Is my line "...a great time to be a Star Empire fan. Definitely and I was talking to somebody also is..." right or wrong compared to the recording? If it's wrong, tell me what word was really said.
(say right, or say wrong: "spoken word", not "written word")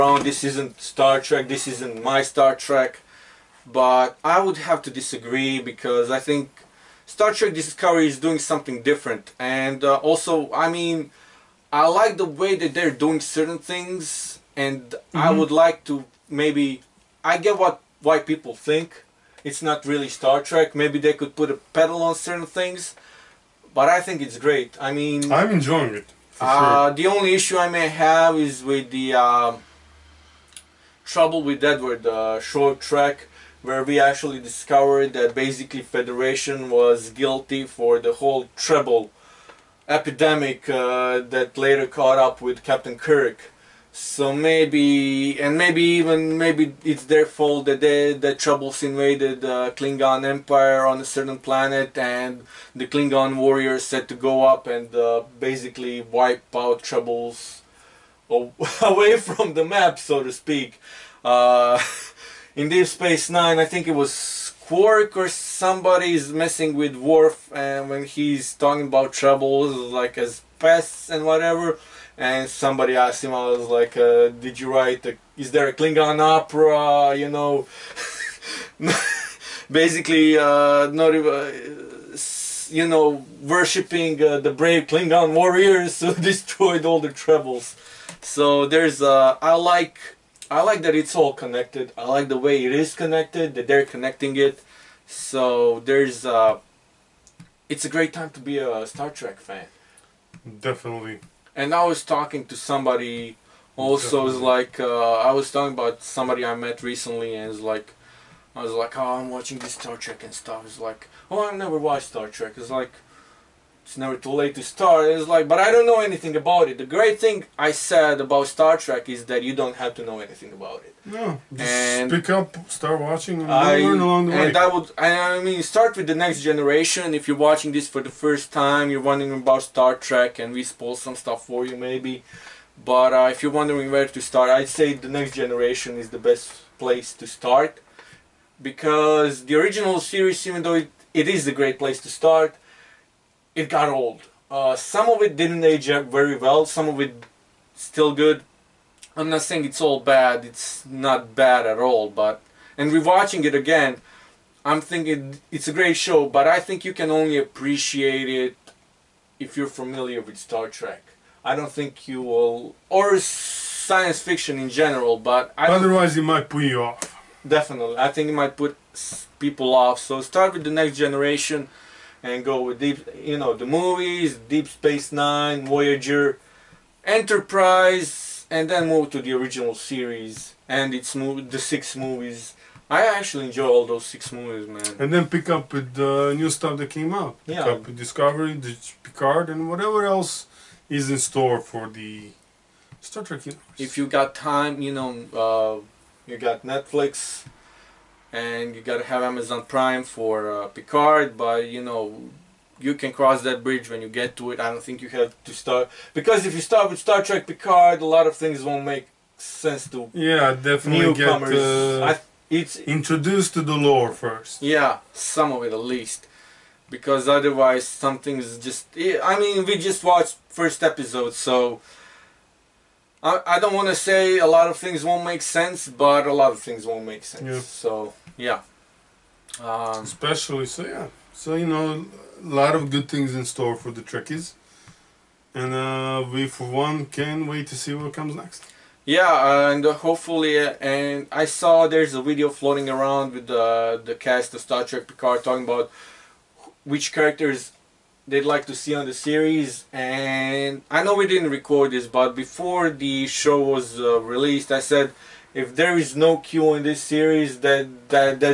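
wrong: "Trek", not "Empire".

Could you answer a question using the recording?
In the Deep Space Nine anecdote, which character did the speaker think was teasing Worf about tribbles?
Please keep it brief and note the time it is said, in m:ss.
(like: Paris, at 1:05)
Quark, at 1:04.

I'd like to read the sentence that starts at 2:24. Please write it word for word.
Uh, some of it didn't age up very well, some of it still good.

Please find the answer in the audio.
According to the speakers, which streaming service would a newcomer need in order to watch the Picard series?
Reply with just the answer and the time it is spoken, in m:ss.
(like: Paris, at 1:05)
Amazon Prime, at 3:19.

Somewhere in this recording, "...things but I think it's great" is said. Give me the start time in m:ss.
0:22.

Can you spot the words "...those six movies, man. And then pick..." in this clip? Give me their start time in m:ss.
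3:03.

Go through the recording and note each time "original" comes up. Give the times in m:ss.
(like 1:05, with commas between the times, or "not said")
2:19, 2:59.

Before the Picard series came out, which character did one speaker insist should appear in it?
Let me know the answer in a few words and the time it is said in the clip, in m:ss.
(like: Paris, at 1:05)
Q, at 4:16.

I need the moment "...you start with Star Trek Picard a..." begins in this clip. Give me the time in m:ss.
3:26.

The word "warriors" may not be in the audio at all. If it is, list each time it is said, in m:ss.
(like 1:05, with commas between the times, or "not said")
0:53, 1:25.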